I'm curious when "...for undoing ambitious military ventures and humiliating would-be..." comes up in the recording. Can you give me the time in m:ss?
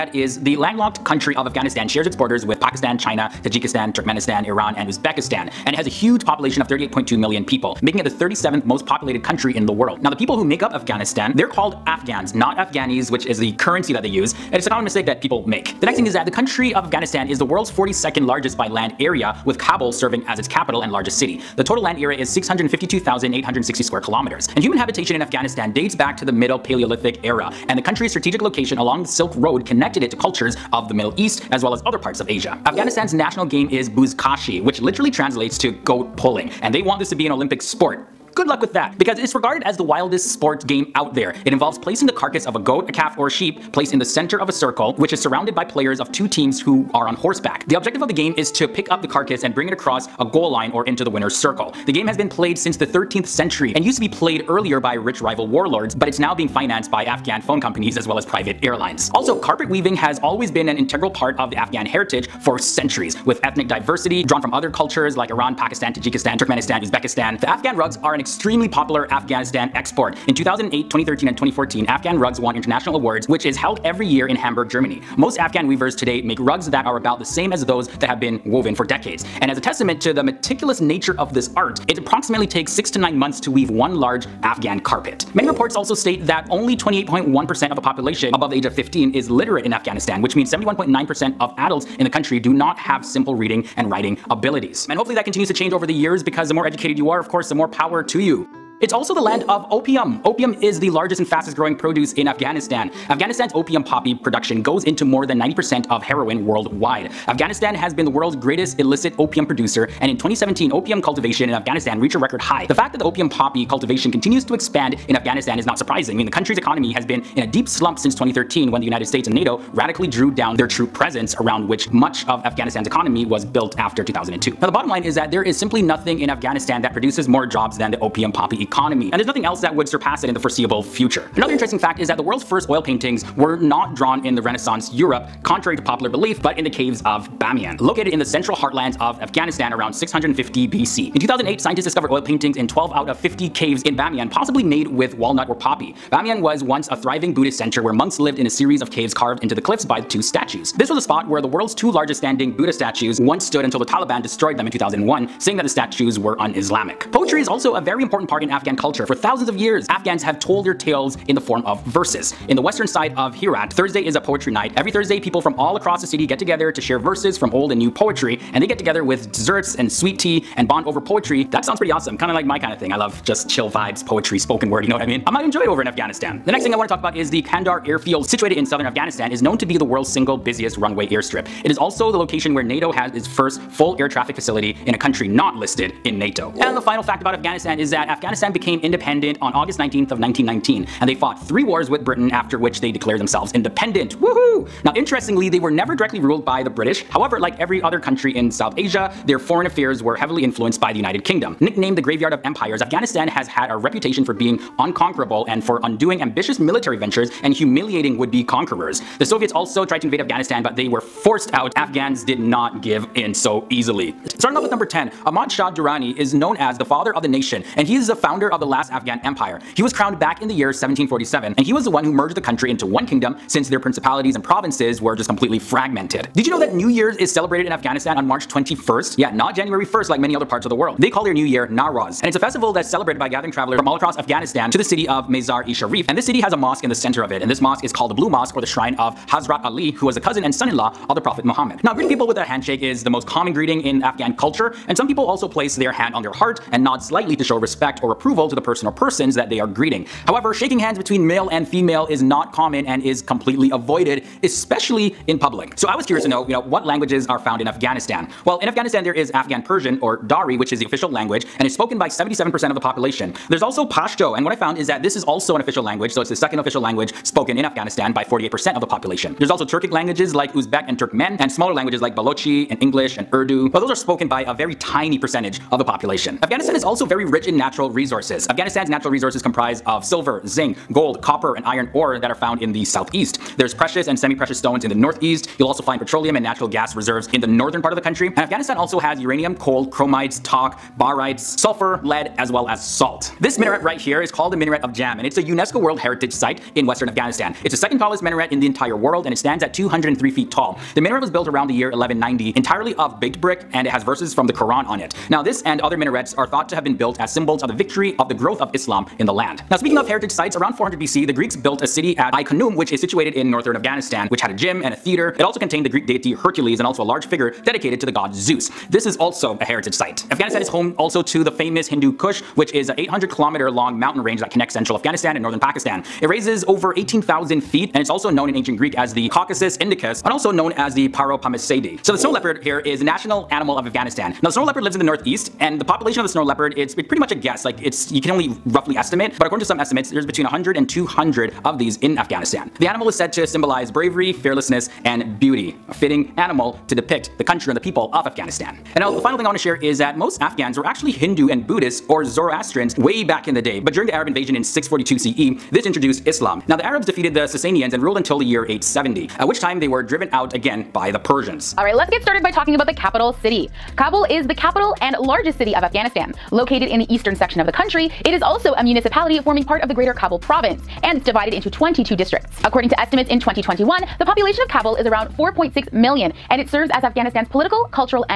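3:25.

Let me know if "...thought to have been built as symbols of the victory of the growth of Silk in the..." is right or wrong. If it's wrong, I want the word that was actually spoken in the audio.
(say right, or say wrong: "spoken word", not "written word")
wrong: "Islam", not "Silk".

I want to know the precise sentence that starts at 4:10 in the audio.
However, shaking hands between male and female is not common and is completely avoided especially in public.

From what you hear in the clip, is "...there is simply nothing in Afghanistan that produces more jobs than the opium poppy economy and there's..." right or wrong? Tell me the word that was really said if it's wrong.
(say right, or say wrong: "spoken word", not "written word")
right.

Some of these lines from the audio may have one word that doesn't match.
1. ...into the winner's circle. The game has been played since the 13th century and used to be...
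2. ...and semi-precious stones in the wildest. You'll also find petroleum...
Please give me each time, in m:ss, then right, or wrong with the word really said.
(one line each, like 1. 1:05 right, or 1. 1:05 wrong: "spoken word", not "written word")
1. 0:50 right
2. 4:44 wrong: "northeast", not "wildest".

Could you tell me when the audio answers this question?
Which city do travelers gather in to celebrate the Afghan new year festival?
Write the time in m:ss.
3:55.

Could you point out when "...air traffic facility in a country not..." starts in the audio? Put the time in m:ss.
3:03.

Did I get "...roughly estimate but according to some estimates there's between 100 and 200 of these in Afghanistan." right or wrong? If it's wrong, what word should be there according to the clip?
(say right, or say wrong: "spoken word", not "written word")
right.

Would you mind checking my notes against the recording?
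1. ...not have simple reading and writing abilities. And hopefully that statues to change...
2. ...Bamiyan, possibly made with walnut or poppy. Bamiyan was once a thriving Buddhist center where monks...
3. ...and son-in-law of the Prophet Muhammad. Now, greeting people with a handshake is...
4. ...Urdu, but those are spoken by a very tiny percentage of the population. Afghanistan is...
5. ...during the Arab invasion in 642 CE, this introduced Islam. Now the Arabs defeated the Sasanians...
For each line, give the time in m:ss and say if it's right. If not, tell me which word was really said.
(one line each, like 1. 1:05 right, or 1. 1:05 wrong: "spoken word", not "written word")
1. 1:32 wrong: "continues", not "statues"
2. 2:23 right
3. 4:00 right
4. 4:33 right
5. 5:53 right.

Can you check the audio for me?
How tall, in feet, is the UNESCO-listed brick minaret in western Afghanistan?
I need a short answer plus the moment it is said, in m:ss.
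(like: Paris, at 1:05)
203 feet, at 4:59.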